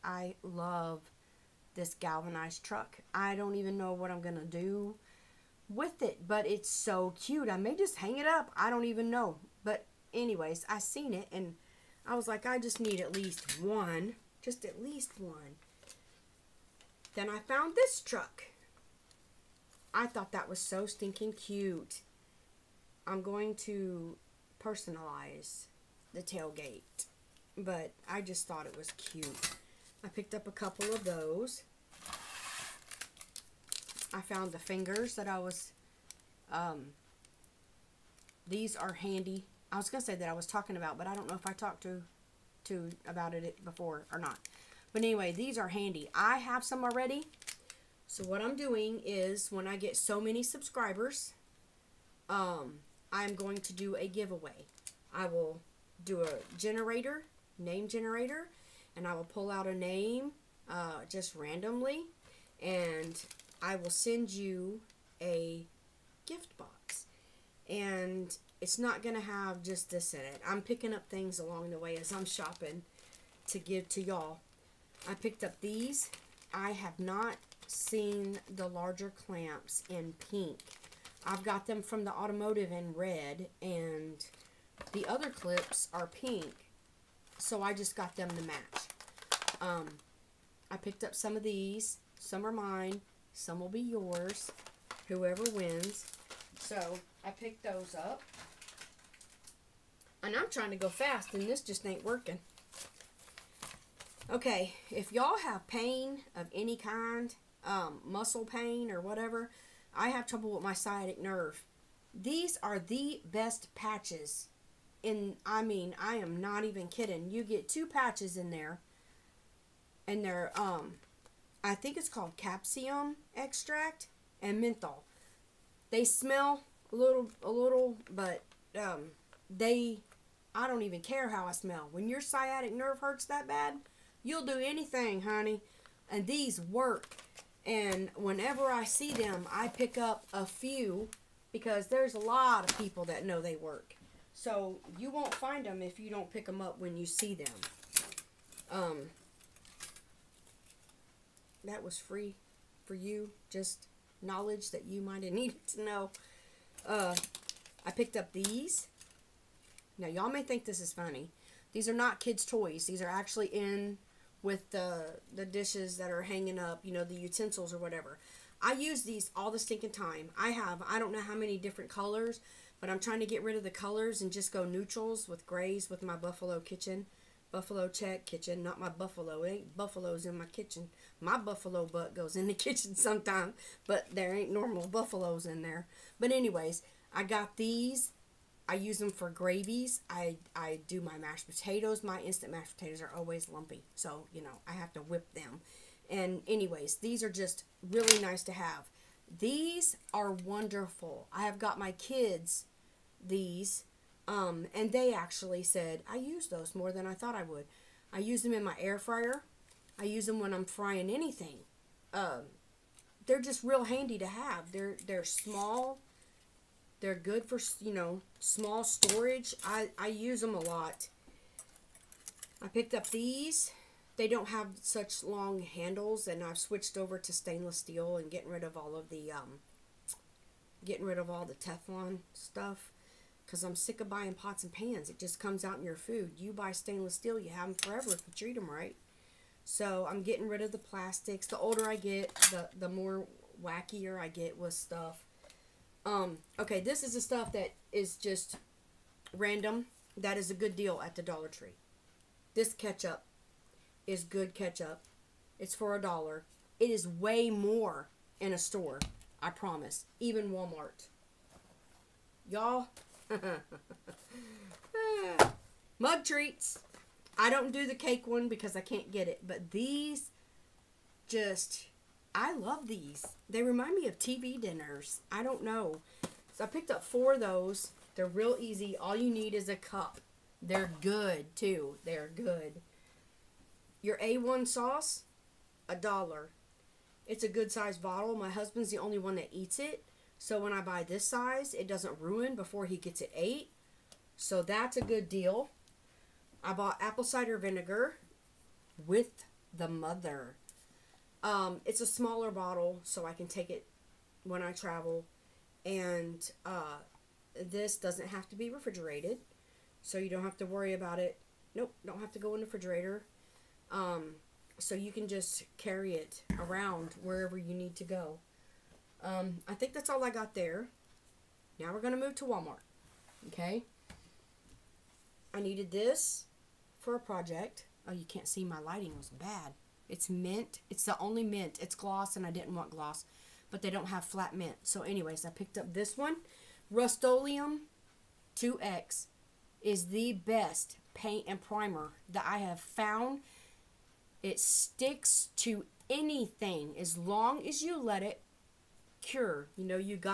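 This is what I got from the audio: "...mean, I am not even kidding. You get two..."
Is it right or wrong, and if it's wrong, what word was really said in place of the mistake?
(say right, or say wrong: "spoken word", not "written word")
right.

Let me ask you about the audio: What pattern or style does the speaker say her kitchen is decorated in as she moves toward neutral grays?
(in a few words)
Buffalo check.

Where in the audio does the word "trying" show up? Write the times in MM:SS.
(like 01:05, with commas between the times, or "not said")
01:40, 02:52.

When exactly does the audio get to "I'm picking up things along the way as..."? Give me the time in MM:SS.
01:10.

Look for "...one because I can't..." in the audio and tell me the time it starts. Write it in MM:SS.
04:28.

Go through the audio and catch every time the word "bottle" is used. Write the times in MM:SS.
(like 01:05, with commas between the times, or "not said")
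04:48, 05:02.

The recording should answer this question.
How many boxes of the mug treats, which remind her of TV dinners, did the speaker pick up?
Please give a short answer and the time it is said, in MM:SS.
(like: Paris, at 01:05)
4, at 04:37.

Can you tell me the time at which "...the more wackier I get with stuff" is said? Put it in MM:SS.
04:02.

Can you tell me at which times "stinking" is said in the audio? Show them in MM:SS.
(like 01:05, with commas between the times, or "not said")
00:20, 02:49.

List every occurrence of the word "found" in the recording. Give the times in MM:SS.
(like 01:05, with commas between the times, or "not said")
00:17, 00:34, 05:42.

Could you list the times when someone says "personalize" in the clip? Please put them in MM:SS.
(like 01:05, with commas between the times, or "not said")
00:24.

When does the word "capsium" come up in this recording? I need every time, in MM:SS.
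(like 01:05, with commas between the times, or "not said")
02:02.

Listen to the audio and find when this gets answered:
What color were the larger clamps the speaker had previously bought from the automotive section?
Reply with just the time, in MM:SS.
01:22.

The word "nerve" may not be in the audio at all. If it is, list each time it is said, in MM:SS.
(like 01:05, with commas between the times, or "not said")
01:51, 02:12.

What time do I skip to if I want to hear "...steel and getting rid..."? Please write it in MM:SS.
03:47.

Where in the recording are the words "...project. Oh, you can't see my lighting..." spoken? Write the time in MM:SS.
05:27.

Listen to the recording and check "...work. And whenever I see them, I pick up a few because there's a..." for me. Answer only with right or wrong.
right.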